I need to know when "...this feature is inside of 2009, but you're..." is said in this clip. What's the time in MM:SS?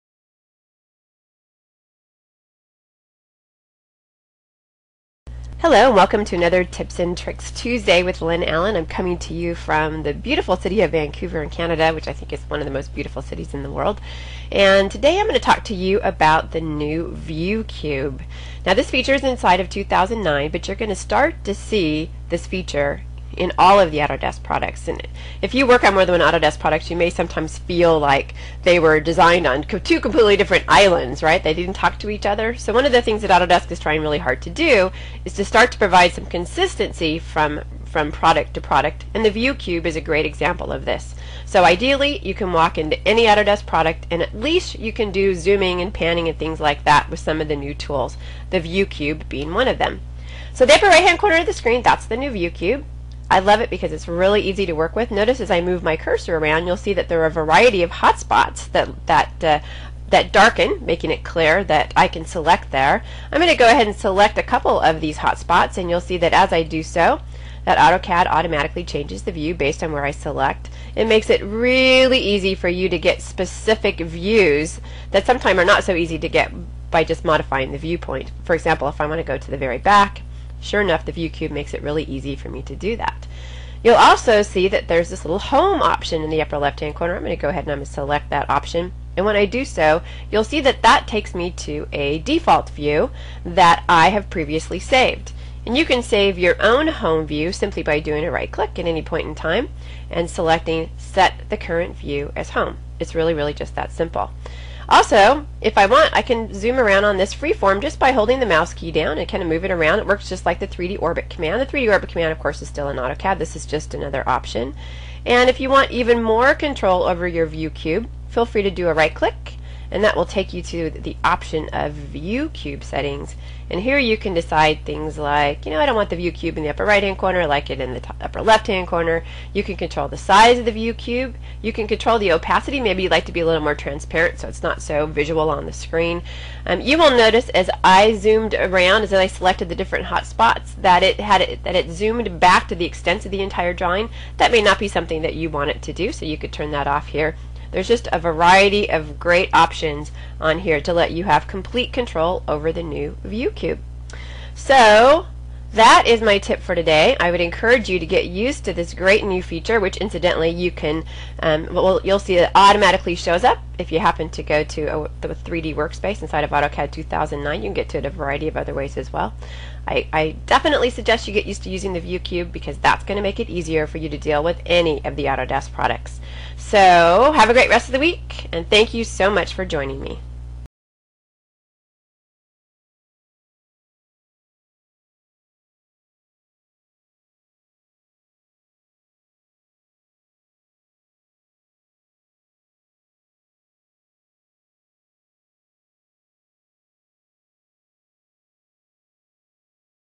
00:18.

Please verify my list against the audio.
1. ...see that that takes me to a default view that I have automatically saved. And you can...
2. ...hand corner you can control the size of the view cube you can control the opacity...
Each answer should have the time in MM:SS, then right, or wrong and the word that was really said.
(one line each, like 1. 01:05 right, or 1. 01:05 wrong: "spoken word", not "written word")
1. 01:30 wrong: "previously", not "automatically"
2. 02:08 right.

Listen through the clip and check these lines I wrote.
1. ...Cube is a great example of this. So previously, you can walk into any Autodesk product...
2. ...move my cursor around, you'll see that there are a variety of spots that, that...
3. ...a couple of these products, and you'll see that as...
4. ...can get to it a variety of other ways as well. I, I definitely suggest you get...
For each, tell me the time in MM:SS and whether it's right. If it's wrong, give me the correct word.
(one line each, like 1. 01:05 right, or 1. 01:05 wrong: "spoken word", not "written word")
1. 00:39 wrong: "ideally", not "previously"
2. 00:55 wrong: "hotspots", not "spots"
3. 01:04 wrong: "hotspots", not "products"
4. 02:47 right.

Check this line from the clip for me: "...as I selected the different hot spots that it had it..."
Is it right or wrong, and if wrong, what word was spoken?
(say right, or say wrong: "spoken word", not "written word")
right.